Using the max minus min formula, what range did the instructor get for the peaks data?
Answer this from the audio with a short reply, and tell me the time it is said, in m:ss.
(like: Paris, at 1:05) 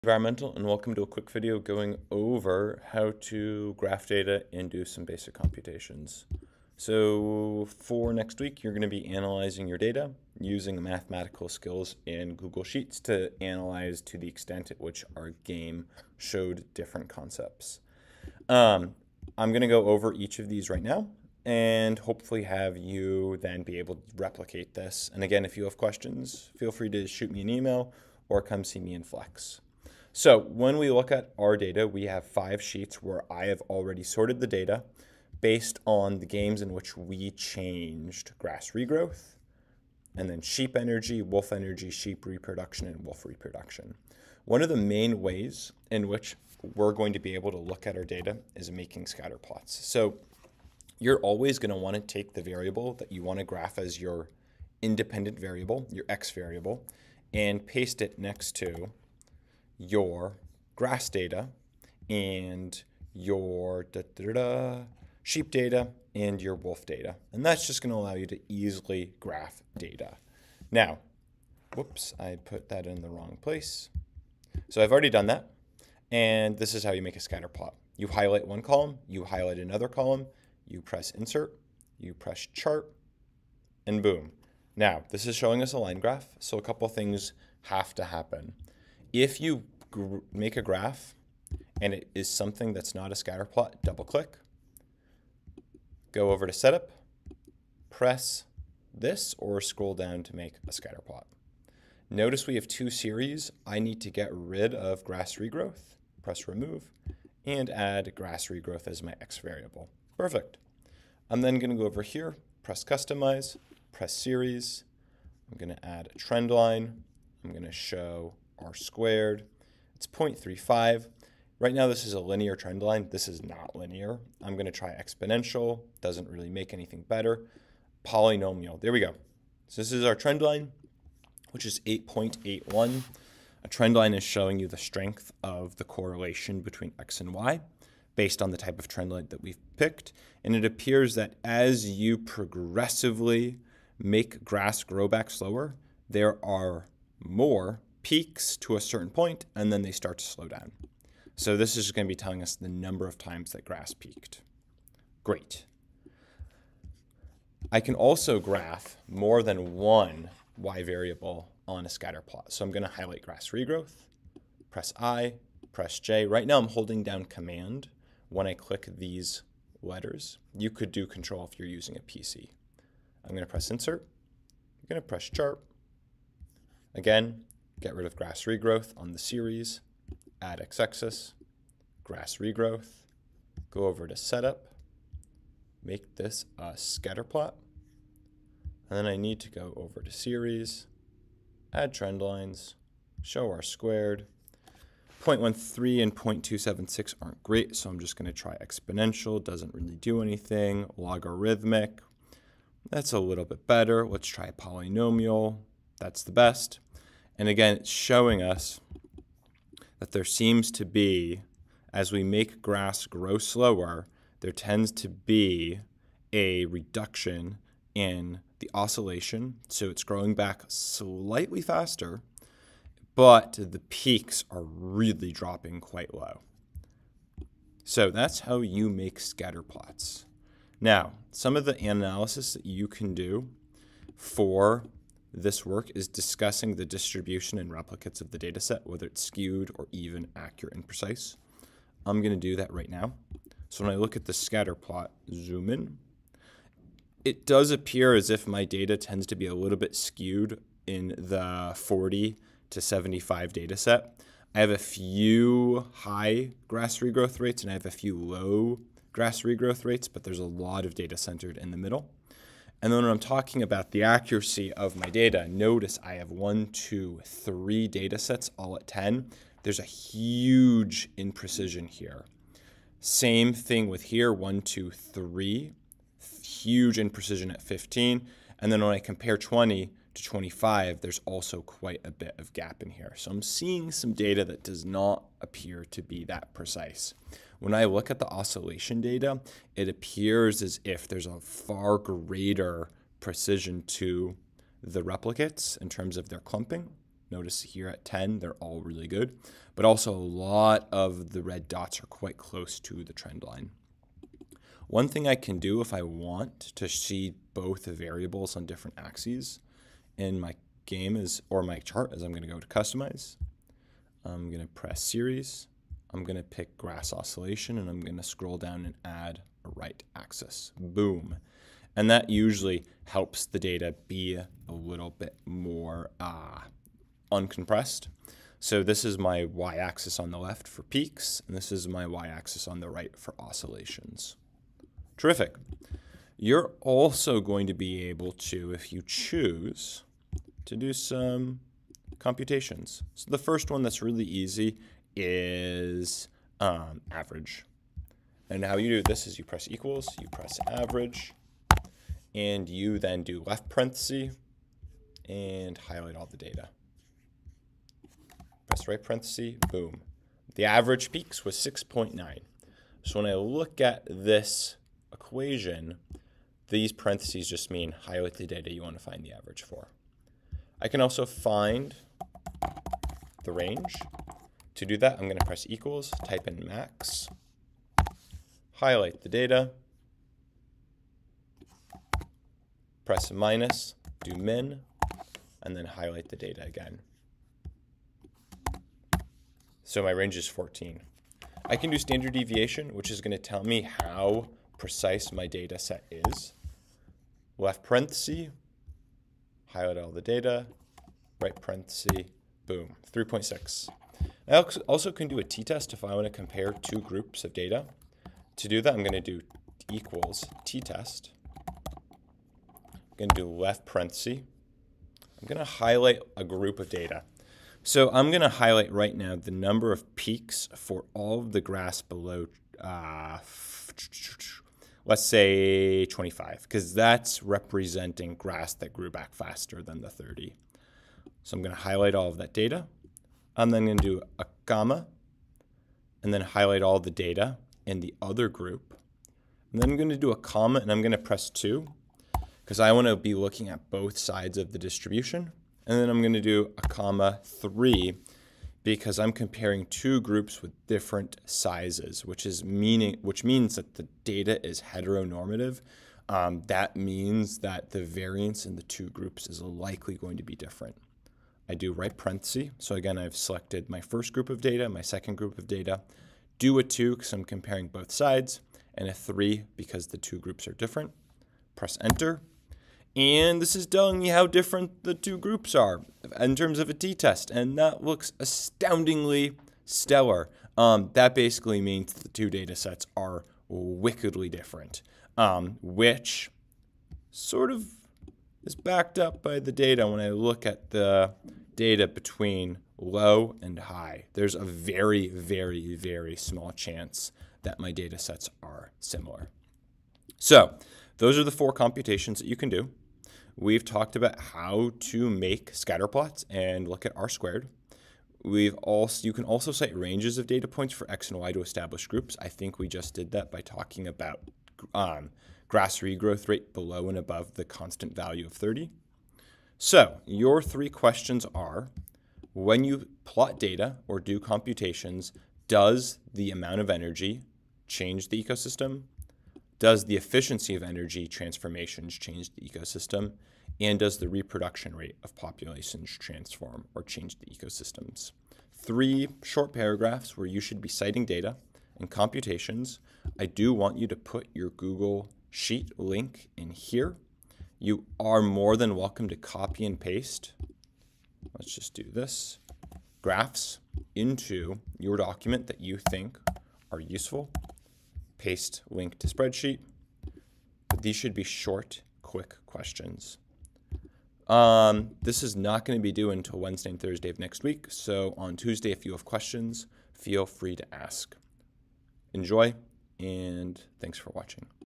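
14, at 6:30.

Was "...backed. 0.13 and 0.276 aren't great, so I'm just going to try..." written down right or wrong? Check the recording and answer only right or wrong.
wrong.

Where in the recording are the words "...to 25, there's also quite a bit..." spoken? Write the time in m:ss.
4:40.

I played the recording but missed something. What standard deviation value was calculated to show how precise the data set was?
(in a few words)
3.6.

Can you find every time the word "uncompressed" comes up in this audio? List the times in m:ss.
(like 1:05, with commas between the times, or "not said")
5:27.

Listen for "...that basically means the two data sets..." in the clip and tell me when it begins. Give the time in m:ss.
8:01.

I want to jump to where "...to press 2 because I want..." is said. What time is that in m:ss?
7:21.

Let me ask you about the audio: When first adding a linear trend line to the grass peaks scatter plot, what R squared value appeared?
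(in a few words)
0.35.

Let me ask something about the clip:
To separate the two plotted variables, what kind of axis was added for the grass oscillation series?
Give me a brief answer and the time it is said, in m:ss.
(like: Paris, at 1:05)
Right axis, at 5:19.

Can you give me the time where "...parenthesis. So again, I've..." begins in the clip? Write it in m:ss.
7:42.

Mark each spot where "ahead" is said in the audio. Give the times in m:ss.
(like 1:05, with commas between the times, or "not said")
not said.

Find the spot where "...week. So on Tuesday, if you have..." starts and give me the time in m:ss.
9:27.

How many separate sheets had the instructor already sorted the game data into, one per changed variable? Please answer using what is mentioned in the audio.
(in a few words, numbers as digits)
5.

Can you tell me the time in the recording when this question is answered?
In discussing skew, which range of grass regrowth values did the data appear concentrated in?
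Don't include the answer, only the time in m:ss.
4:11.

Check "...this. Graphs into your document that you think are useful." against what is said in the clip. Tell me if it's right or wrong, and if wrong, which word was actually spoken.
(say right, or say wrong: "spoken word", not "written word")
right.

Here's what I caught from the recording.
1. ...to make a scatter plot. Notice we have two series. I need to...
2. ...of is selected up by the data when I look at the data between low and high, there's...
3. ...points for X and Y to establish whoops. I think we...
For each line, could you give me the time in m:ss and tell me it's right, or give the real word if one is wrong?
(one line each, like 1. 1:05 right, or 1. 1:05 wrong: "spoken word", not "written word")
1. 1:40 right
2. 8:07 wrong: "backed", not "selected"
3. 8:30 wrong: "groups", not "whoops".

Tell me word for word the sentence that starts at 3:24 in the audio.
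Let's try polynomial, that's the best.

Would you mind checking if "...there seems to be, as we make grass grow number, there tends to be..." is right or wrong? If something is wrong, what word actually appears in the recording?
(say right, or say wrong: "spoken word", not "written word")
wrong: "slower", not "number".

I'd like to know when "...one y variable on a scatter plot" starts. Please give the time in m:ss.
2:39.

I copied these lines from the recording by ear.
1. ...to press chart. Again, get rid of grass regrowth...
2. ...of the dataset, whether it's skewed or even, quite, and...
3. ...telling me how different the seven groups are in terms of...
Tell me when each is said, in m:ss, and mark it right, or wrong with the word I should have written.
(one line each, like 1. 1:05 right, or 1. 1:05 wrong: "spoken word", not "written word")
1. 2:55 right
2. 3:58 wrong: "accurate", not "quite"
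3. 7:53 wrong: "two", not "seven".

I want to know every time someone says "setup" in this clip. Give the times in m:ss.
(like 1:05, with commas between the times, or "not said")
1:36, 3:04.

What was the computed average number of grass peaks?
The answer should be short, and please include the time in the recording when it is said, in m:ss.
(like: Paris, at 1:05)
6.9, at 6:01.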